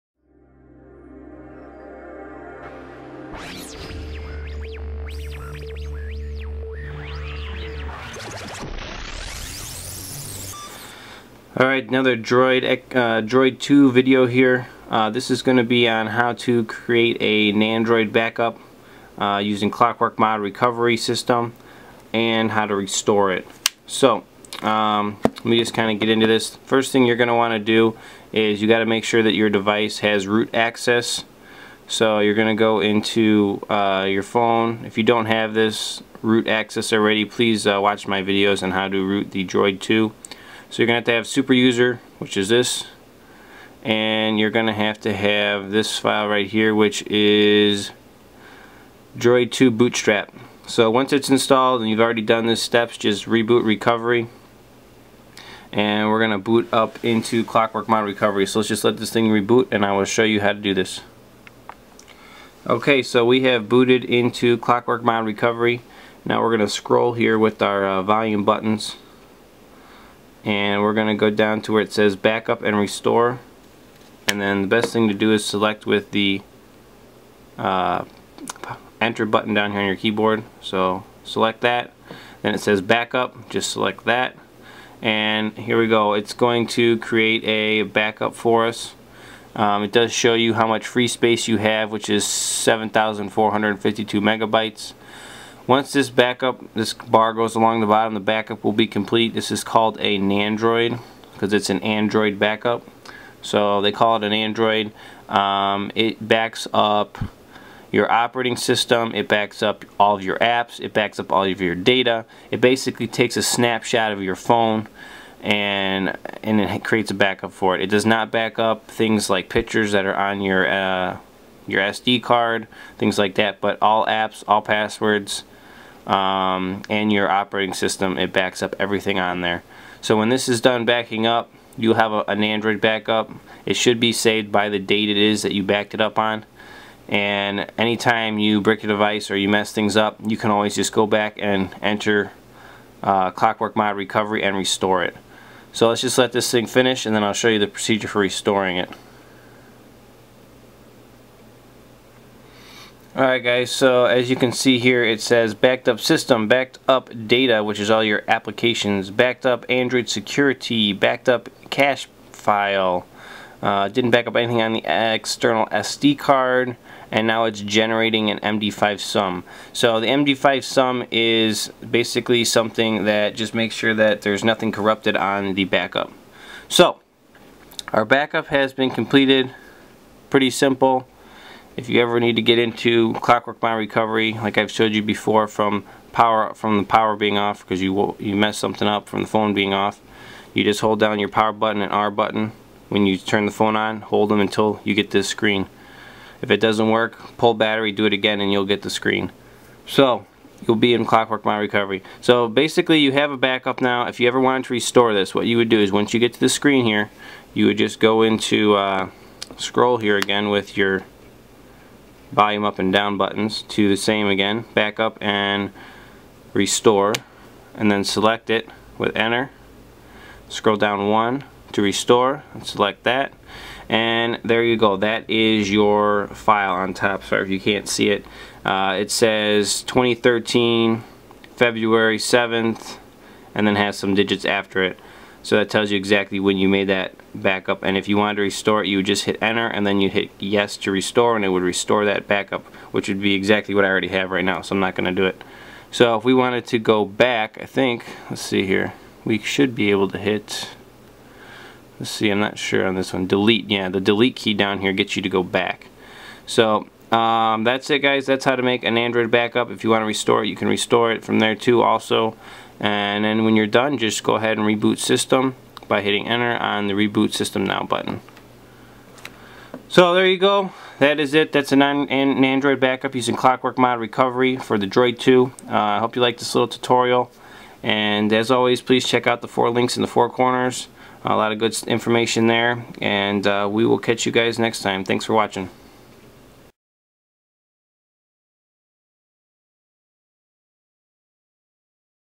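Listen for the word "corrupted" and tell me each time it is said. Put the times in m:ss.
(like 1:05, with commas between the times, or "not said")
2:54.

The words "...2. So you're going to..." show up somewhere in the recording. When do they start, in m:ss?
0:39.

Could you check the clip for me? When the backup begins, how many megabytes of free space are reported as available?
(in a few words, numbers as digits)
7,452.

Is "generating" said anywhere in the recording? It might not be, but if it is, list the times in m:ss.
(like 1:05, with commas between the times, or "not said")
2:47.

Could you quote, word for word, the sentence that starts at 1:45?
Um, it backs up your operating system, it backs up all of your apps, it backs up all of your data.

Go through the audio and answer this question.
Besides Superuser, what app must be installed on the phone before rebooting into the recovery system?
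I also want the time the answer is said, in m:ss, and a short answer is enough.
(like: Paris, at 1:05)
Droid 2 Bootstrap, at 0:49.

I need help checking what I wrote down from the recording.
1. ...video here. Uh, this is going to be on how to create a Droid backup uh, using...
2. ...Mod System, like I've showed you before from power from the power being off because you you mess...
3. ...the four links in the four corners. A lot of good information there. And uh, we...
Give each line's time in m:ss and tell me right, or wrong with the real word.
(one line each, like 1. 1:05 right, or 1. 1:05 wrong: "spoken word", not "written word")
1. 0:13 wrong: "Nandroid", not "Droid"
2. 3:03 wrong: "Recovery", not "System"
3. 4:39 right.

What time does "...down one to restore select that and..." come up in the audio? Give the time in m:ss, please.
3:40.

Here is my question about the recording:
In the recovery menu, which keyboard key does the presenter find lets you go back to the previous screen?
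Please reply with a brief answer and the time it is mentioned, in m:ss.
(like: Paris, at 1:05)
Delete key, at 4:14.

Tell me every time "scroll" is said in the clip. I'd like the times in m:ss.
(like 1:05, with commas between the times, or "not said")
1:06, 3:29, 3:40.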